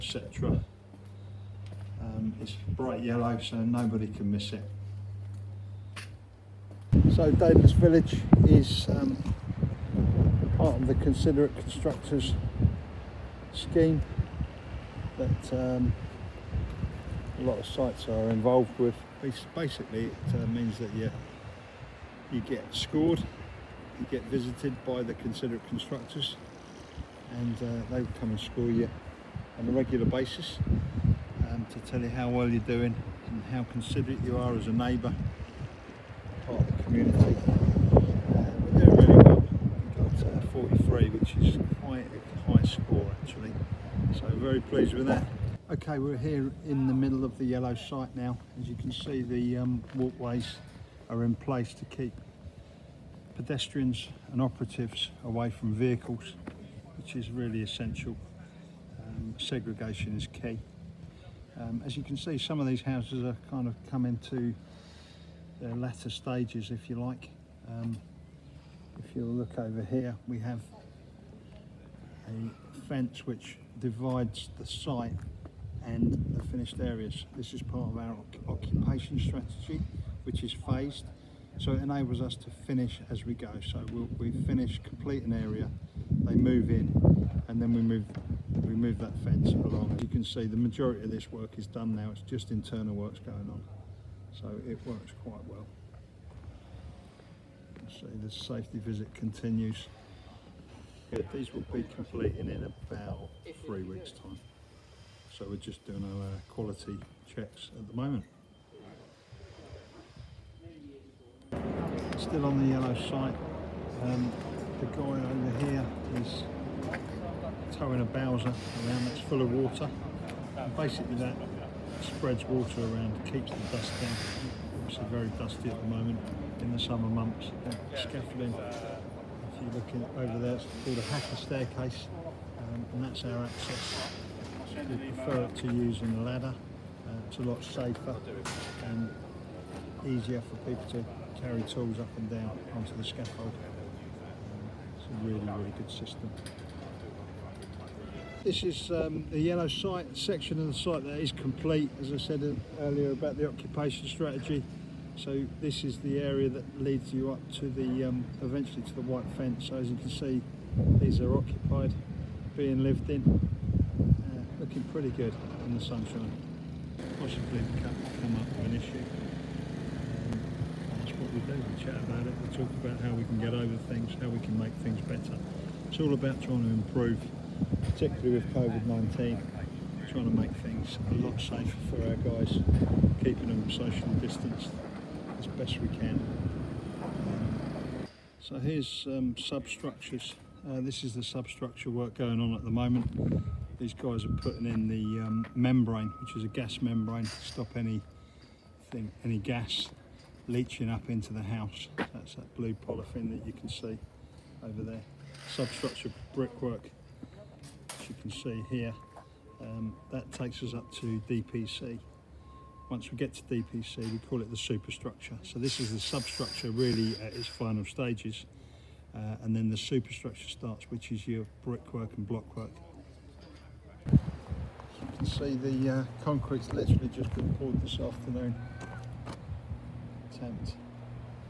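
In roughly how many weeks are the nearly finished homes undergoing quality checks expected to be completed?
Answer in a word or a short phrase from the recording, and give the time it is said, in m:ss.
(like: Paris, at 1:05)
3 weeks, at 1:43.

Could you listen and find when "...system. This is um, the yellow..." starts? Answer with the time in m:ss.
2:25.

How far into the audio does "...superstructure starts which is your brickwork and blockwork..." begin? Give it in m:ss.
3:39.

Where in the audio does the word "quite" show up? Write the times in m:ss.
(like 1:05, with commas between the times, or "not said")
0:41, 1:35.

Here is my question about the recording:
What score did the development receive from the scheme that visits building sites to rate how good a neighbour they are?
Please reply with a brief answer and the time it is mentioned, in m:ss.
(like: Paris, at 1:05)
43, at 0:40.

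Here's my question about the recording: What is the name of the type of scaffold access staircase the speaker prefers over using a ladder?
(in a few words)
Haki staircase.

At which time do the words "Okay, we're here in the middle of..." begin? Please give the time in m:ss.
0:45.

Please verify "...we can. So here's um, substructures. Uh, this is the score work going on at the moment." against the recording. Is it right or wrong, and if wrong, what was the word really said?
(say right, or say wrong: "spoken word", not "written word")
wrong: "substructure", not "score".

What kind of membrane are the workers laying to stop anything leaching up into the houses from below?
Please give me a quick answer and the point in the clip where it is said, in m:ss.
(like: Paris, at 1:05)
gas membrane, at 3:16.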